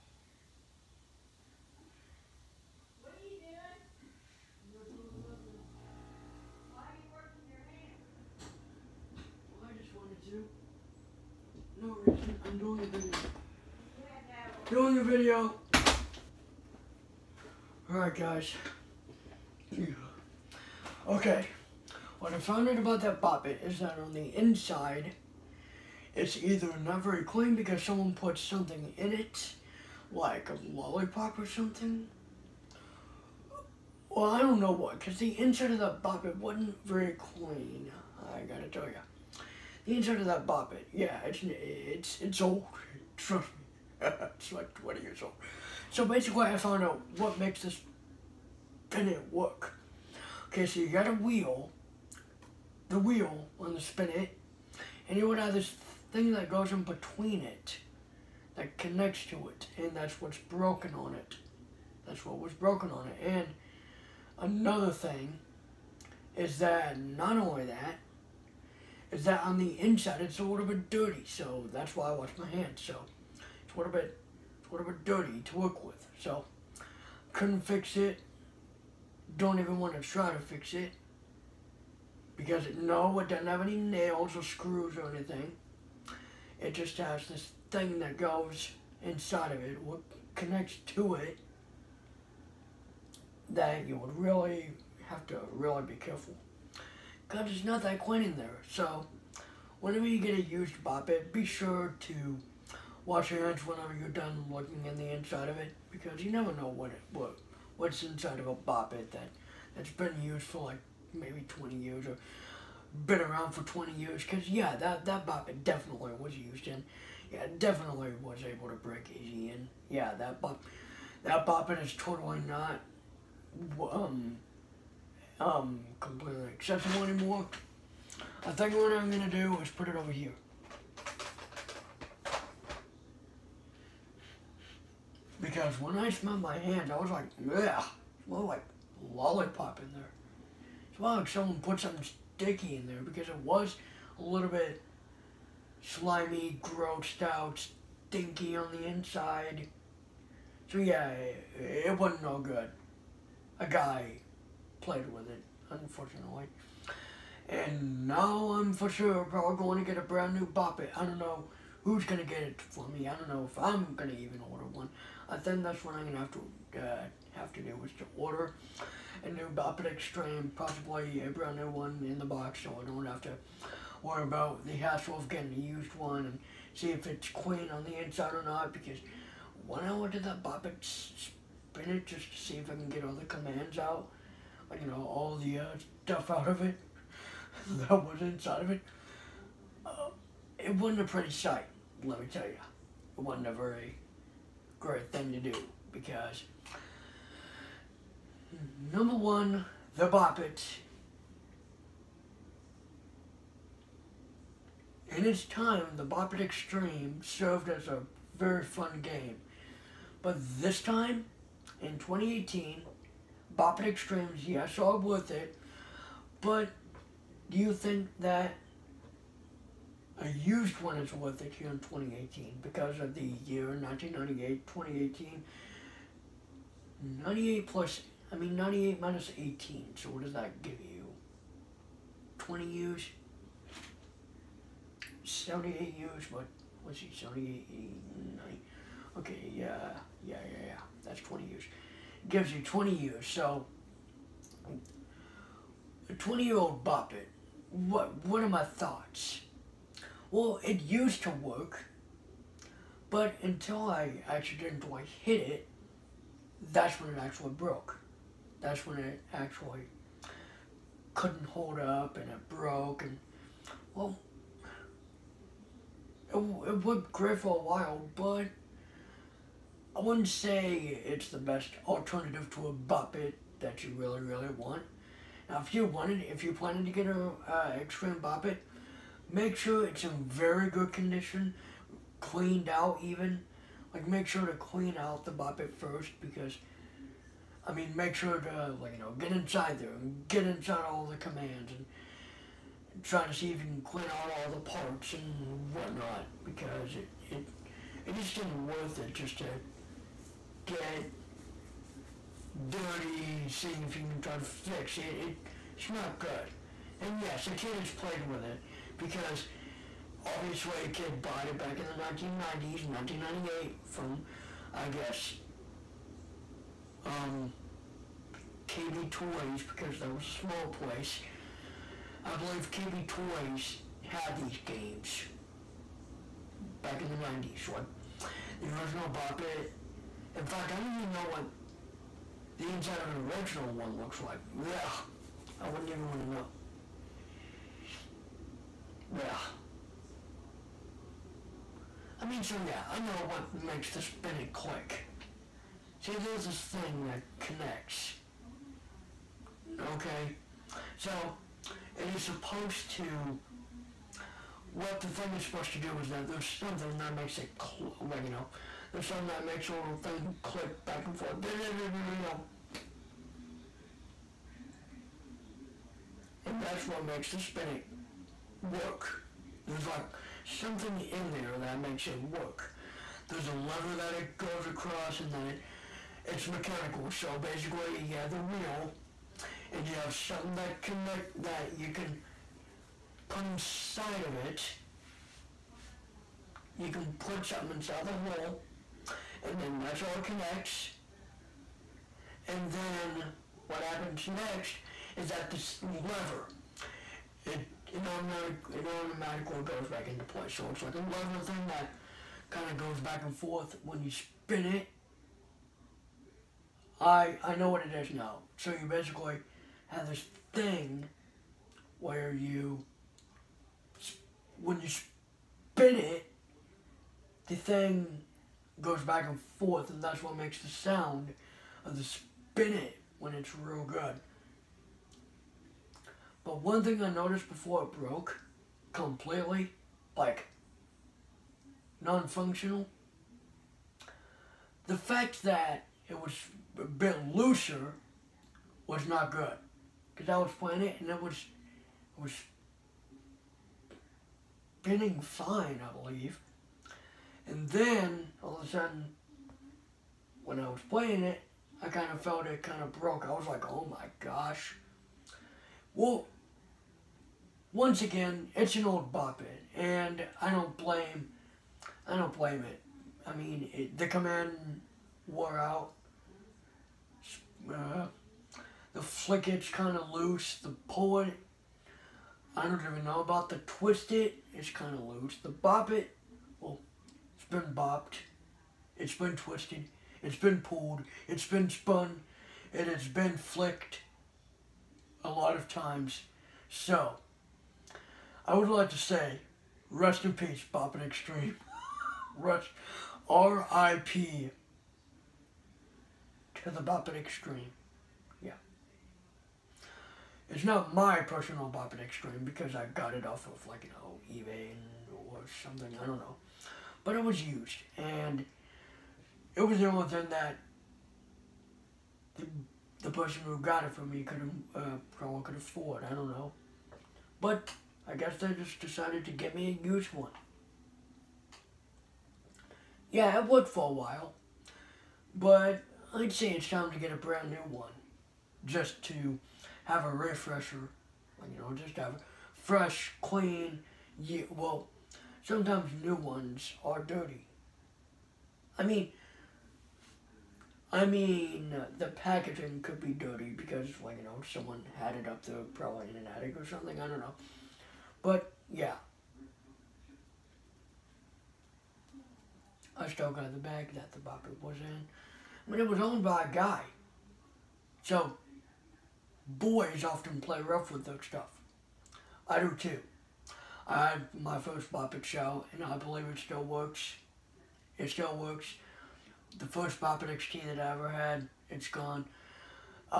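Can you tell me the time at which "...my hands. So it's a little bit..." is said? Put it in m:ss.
1:12.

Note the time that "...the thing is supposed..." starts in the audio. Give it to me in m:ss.
5:55.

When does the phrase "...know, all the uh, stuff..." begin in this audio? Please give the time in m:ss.
3:04.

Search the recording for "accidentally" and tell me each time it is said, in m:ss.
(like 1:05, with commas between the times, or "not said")
4:14.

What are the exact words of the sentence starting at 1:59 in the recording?
yeah that bop that bop it is totally not um um, completely acceptable anymore.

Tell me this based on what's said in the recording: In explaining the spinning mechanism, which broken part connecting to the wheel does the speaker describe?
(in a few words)
thing that goes in between it.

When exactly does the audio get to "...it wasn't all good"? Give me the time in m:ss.
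2:31.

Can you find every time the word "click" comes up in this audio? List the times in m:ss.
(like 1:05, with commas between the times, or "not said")
5:44, 6:00.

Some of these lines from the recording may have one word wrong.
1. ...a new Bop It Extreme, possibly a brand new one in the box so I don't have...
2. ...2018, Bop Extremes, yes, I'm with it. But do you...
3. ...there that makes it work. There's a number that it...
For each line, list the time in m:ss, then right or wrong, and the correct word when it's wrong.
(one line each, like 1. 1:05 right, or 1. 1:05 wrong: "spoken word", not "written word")
1. 2:49 right
2. 3:31 right
3. 6:11 wrong: "lever", not "number".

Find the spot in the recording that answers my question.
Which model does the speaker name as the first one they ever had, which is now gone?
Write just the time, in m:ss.
9:30.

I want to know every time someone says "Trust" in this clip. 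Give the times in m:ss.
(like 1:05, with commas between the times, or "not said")
0:43.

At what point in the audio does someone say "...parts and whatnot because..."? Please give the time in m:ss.
4:54.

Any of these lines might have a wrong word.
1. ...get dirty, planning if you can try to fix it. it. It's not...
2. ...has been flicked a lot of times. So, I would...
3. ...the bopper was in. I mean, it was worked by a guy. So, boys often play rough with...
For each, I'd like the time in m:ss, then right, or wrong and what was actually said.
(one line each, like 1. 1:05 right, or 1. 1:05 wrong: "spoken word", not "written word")
1. 5:00 wrong: "seeing", not "planning"
2. 8:02 right
3. 9:14 wrong: "owned", not "worked".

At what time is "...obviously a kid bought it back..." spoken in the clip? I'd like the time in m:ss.
5:10.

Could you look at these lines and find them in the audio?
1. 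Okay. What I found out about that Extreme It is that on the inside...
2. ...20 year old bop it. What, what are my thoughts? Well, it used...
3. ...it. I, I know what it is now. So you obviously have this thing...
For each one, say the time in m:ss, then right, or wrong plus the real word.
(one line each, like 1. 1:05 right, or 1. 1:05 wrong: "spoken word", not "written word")
1. 0:21 wrong: "Bop", not "Extreme"
2. 4:06 right
3. 6:44 wrong: "basically", not "obviously".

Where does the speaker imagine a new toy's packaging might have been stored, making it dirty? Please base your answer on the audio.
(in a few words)
an attic.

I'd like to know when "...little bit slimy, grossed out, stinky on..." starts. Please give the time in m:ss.
2:24.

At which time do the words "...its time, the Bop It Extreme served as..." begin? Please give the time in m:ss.
3:25.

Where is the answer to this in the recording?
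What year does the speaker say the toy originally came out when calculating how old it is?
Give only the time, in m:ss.
3:43.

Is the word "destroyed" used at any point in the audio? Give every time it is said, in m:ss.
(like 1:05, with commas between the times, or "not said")
not said.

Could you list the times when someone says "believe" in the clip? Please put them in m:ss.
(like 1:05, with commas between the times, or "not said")
5:22, 7:25, 9:25.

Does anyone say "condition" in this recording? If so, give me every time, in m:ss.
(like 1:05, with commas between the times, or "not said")
4:40.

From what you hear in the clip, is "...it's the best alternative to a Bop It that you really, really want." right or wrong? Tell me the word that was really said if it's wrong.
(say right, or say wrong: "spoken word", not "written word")
right.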